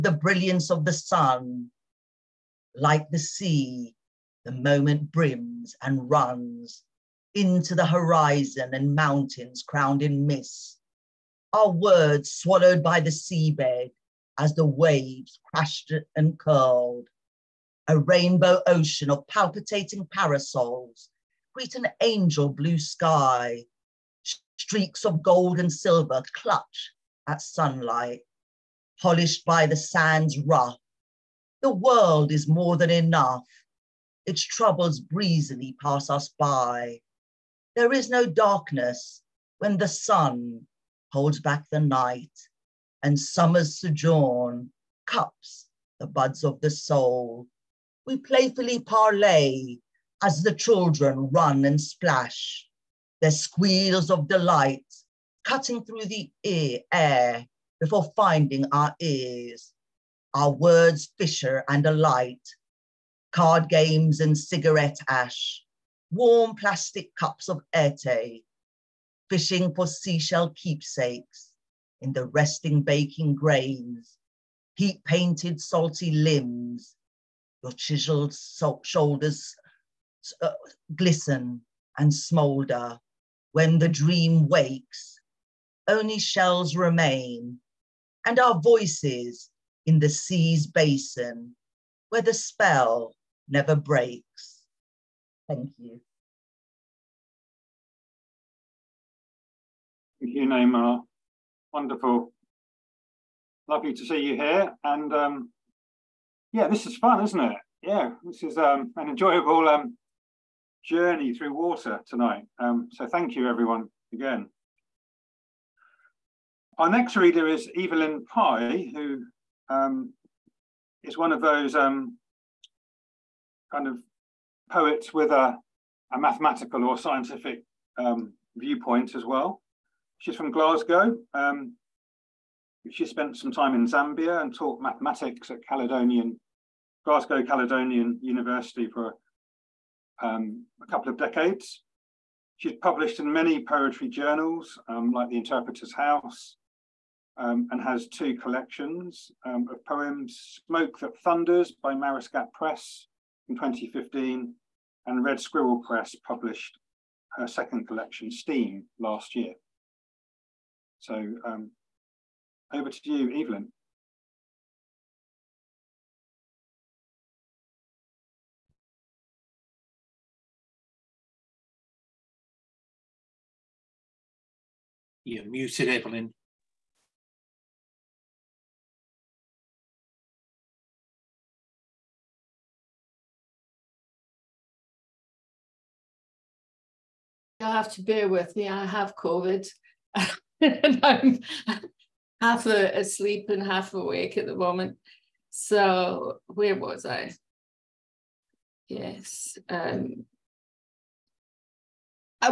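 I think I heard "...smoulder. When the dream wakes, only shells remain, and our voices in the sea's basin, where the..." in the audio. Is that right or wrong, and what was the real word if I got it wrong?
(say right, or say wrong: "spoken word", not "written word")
right.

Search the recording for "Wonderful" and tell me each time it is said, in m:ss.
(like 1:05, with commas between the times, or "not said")
1:41.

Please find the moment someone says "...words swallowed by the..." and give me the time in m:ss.
0:11.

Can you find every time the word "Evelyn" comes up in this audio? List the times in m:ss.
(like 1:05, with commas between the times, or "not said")
1:57, 2:43, 2:55.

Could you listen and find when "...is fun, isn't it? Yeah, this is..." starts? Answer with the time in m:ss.
1:46.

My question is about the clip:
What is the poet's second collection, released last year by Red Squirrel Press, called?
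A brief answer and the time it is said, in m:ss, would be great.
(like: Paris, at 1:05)
Steam, at 2:38.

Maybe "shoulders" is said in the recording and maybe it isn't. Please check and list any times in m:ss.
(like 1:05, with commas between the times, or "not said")
1:18.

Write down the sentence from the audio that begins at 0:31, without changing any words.
The world is more than enough, its troubles breezily pass us by.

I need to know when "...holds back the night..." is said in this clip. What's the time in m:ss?
0:41.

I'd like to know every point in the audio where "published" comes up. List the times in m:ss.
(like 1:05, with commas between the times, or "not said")
2:22, 2:36.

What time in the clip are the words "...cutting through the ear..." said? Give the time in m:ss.
0:55.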